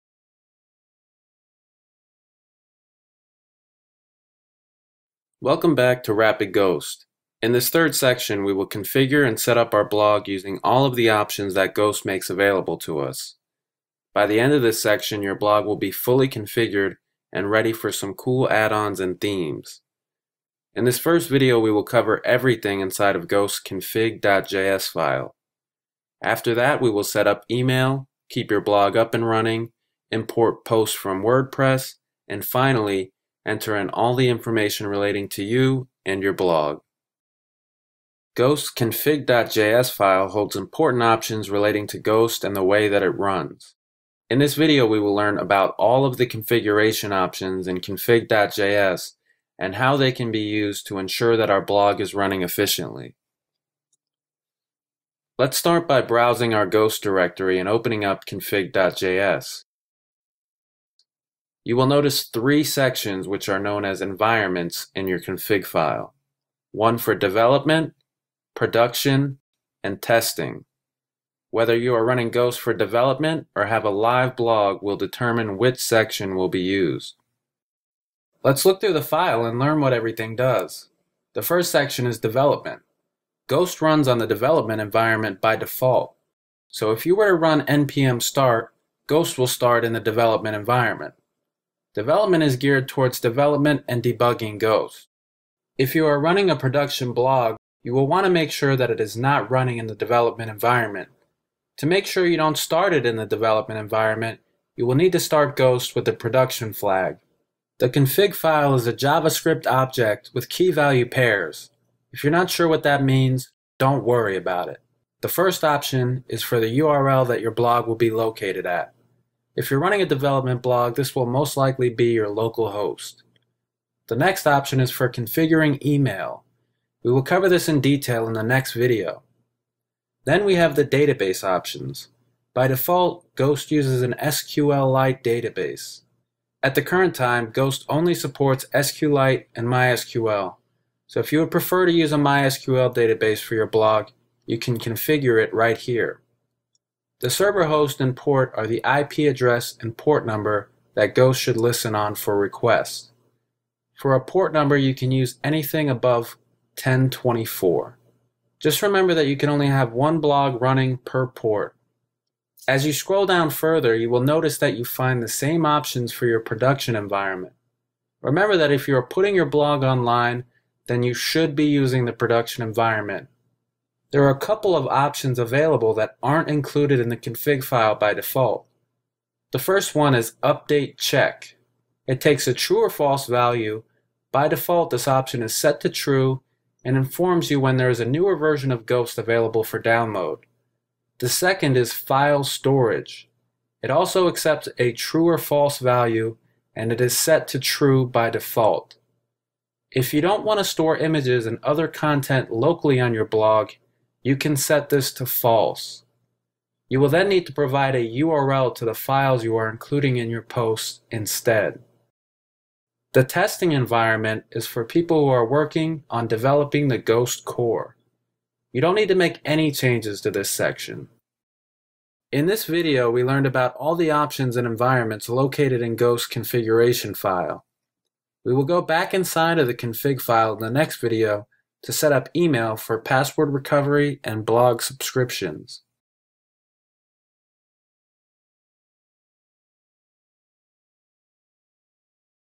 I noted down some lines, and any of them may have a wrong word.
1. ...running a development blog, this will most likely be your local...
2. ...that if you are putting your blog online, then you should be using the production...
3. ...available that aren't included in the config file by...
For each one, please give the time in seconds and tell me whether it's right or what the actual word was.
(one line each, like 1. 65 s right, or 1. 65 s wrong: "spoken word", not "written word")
1. 119 s right
2. 168 s right
3. 175 s right.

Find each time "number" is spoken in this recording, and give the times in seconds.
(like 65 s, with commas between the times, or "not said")
150 s, 154 s.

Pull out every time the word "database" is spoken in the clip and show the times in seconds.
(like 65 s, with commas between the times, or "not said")
130 s, 135 s, 142 s.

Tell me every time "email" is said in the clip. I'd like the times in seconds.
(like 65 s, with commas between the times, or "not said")
27 s, 125 s, 232 s.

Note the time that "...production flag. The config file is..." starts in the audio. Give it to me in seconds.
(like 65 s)
106 s.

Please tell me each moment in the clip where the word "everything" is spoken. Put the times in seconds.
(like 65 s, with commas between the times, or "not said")
22 s, 79 s.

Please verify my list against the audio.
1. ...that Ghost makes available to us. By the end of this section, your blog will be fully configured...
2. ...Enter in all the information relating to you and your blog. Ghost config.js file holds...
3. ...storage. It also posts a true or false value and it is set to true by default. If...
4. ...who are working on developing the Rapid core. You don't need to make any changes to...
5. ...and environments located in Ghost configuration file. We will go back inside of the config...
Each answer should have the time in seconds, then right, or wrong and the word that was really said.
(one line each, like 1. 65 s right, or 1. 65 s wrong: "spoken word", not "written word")
1. 11 s right
2. 33 s right
3. 192 s wrong: "accepts", not "posts"
4. 215 s wrong: "Ghost", not "Rapid"
5. 224 s right.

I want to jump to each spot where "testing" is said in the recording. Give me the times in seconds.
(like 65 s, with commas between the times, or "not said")
70 s, 213 s.